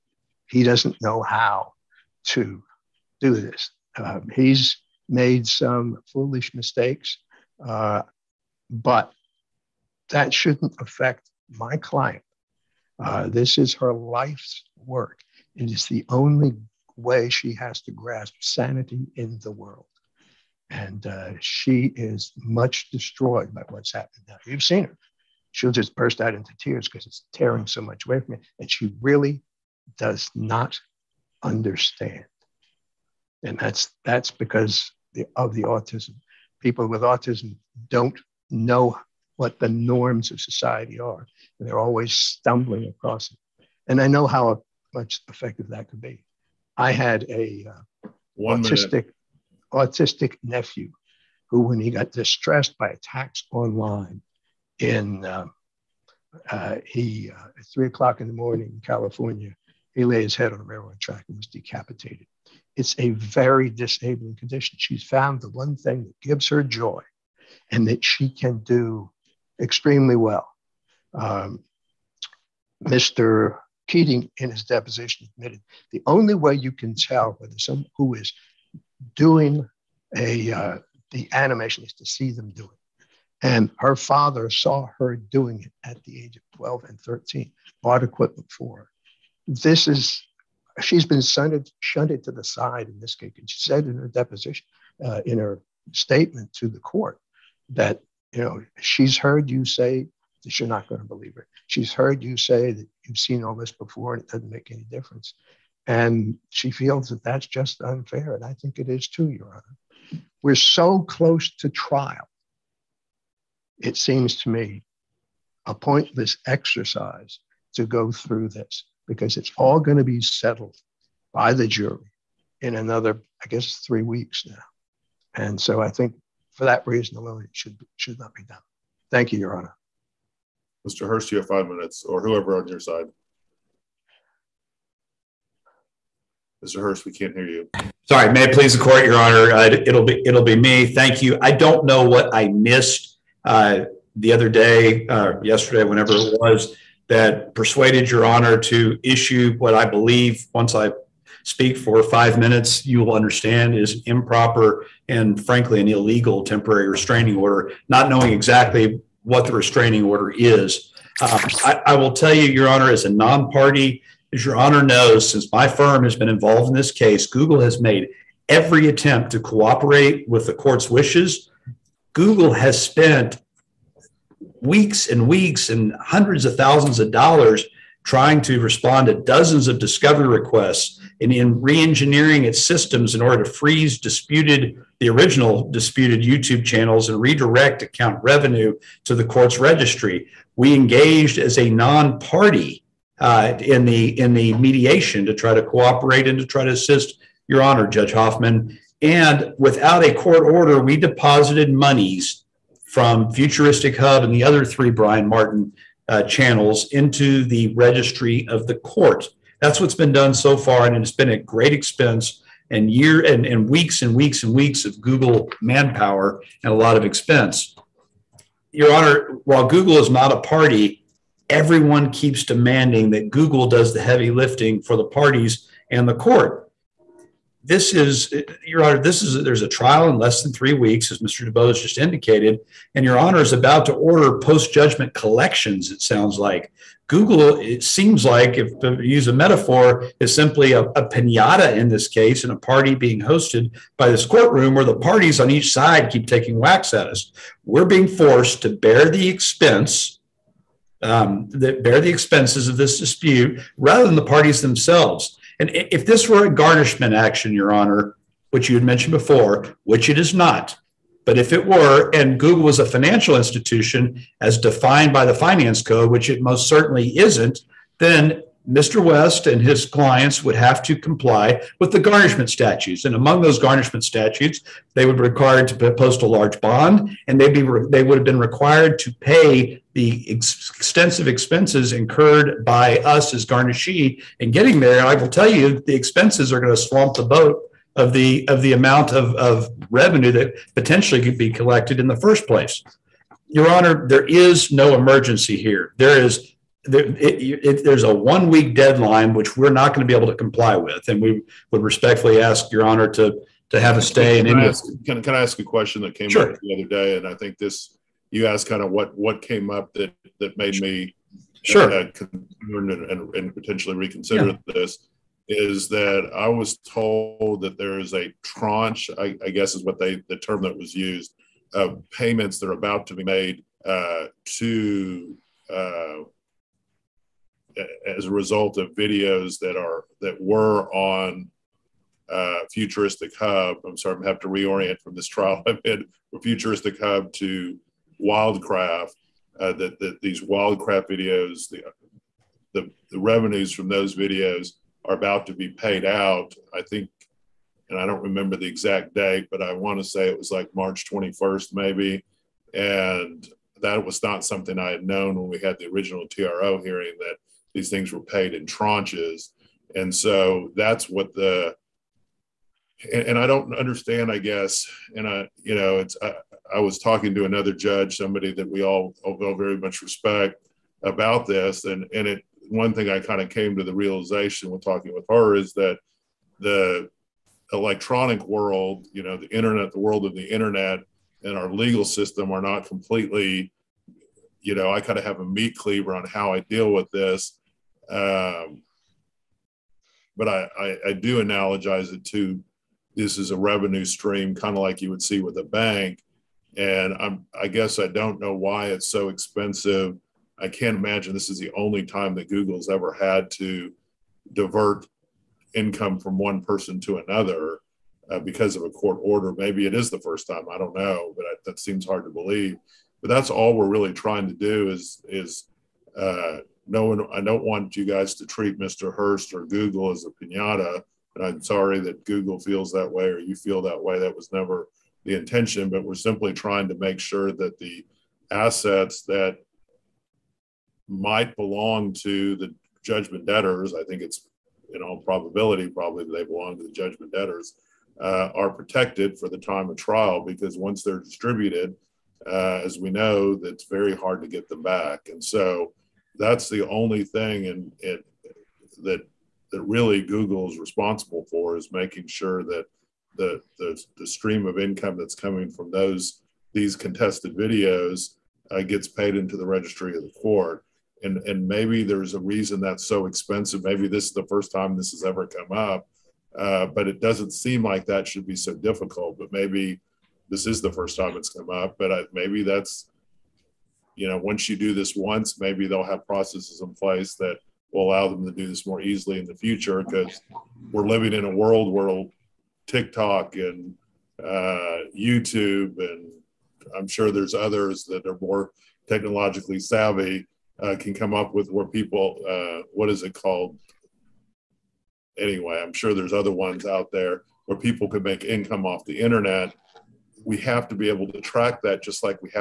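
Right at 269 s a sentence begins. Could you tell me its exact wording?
West and his clients would have to comply with the garnishment statutes.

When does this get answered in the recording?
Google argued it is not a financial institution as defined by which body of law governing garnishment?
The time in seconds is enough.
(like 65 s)
265 s.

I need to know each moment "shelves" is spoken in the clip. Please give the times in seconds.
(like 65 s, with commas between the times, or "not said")
not said.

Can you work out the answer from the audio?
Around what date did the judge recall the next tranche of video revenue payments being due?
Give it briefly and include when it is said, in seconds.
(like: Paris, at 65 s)
March 21, at 350 s.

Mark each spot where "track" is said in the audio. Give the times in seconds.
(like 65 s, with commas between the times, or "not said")
60 s, 501 s.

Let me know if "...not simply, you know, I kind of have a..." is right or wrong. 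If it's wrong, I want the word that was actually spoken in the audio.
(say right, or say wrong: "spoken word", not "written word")
wrong: "completely", not "simply".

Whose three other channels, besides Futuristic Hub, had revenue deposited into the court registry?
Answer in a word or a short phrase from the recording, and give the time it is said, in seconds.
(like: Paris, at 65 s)
Brian Martin, at 204 s.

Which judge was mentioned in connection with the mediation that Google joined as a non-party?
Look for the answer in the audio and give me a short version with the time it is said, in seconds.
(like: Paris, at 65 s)
Judge Hoffman, at 197 s.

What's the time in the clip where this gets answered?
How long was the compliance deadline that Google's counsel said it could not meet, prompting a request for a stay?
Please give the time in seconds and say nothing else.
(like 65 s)
298 s.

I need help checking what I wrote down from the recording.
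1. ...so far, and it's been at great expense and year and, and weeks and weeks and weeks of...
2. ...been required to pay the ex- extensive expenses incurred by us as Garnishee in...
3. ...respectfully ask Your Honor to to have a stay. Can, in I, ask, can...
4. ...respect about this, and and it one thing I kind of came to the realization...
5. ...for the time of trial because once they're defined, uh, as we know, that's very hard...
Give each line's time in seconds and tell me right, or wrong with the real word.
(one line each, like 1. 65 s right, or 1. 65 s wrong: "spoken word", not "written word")
1. 210 s right
2. 278 s right
3. 301 s right
4. 370 s right
5. 439 s wrong: "distributed", not "defined".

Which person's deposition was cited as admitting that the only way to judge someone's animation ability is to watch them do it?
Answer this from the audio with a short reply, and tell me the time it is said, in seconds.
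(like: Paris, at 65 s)
Keating, at 73 s.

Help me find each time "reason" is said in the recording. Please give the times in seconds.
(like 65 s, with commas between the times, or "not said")
126 s, 462 s.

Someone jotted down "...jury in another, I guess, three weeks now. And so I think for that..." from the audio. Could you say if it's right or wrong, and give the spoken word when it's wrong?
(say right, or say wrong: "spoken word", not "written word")
right.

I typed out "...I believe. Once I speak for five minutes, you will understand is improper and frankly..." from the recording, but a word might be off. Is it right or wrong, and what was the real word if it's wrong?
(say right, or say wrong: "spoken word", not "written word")
right.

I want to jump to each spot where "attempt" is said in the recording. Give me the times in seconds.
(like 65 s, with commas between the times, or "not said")
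168 s.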